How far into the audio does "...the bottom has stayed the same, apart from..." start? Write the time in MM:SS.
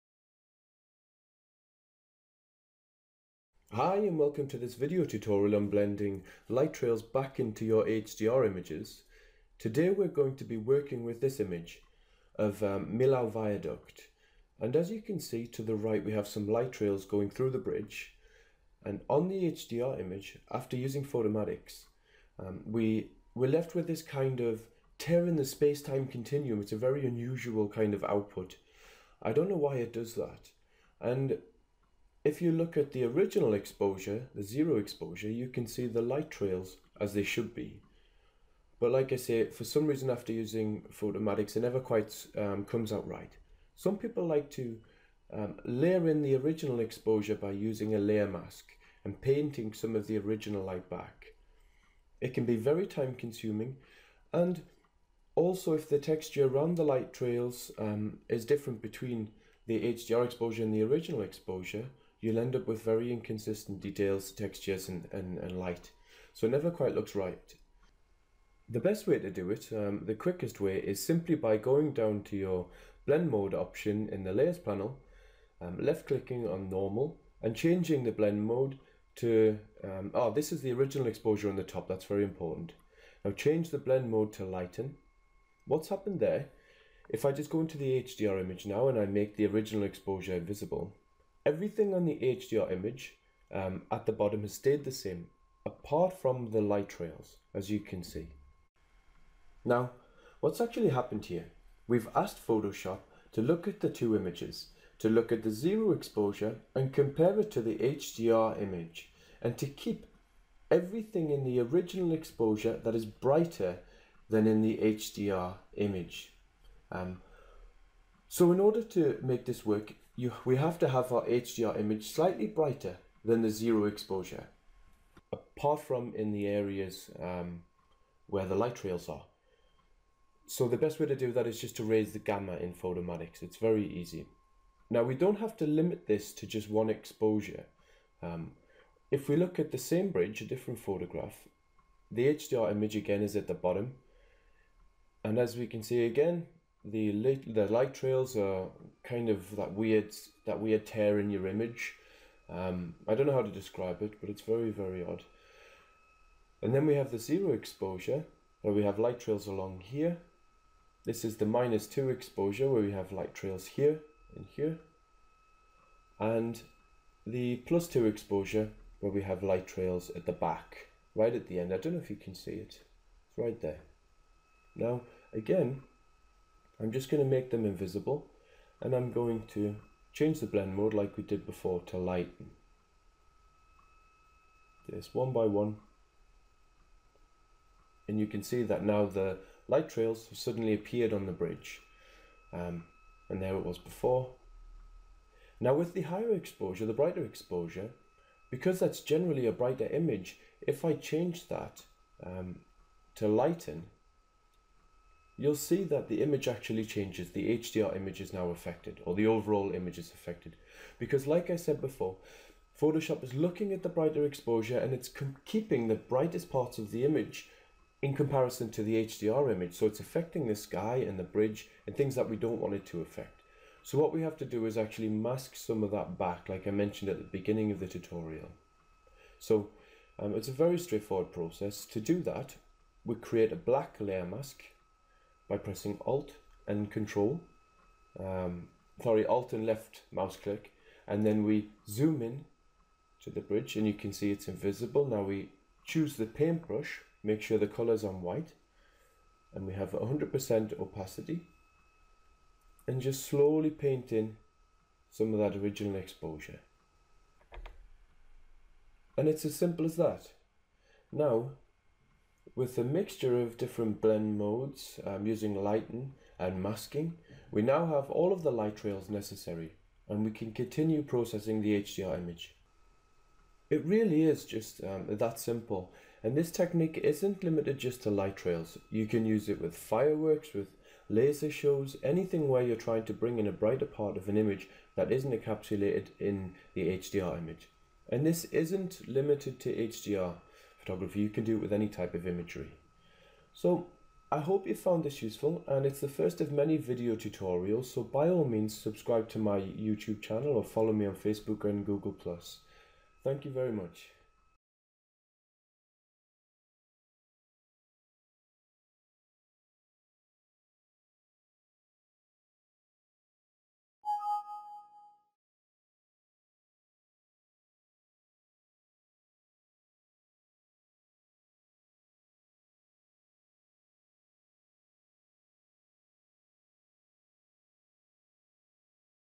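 01:34.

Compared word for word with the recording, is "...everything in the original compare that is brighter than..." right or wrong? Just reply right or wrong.
wrong.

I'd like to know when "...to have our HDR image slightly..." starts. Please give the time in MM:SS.
02:00.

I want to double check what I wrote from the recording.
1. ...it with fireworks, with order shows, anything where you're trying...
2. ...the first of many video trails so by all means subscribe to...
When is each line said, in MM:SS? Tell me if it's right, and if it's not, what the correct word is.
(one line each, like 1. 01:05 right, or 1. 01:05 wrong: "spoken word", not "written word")
1. 04:39 wrong: "laser", not "order"
2. 04:56 wrong: "tutorials", not "trails".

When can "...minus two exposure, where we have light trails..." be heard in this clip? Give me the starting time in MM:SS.
02:41.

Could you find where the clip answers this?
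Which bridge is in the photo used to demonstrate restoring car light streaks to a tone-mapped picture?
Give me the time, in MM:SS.
00:12.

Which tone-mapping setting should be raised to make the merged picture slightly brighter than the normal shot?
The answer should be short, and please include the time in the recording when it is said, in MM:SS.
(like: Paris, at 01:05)
Gamma, at 02:12.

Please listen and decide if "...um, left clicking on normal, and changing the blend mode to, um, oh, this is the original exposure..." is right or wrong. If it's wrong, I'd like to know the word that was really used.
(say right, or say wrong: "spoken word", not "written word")
right.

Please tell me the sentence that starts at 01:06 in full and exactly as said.
So it never quite looks right.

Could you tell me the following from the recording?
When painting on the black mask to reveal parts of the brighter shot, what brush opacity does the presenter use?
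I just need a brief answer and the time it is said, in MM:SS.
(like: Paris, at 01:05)
100%, at 04:09.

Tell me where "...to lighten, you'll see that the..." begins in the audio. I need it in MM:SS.
03:23.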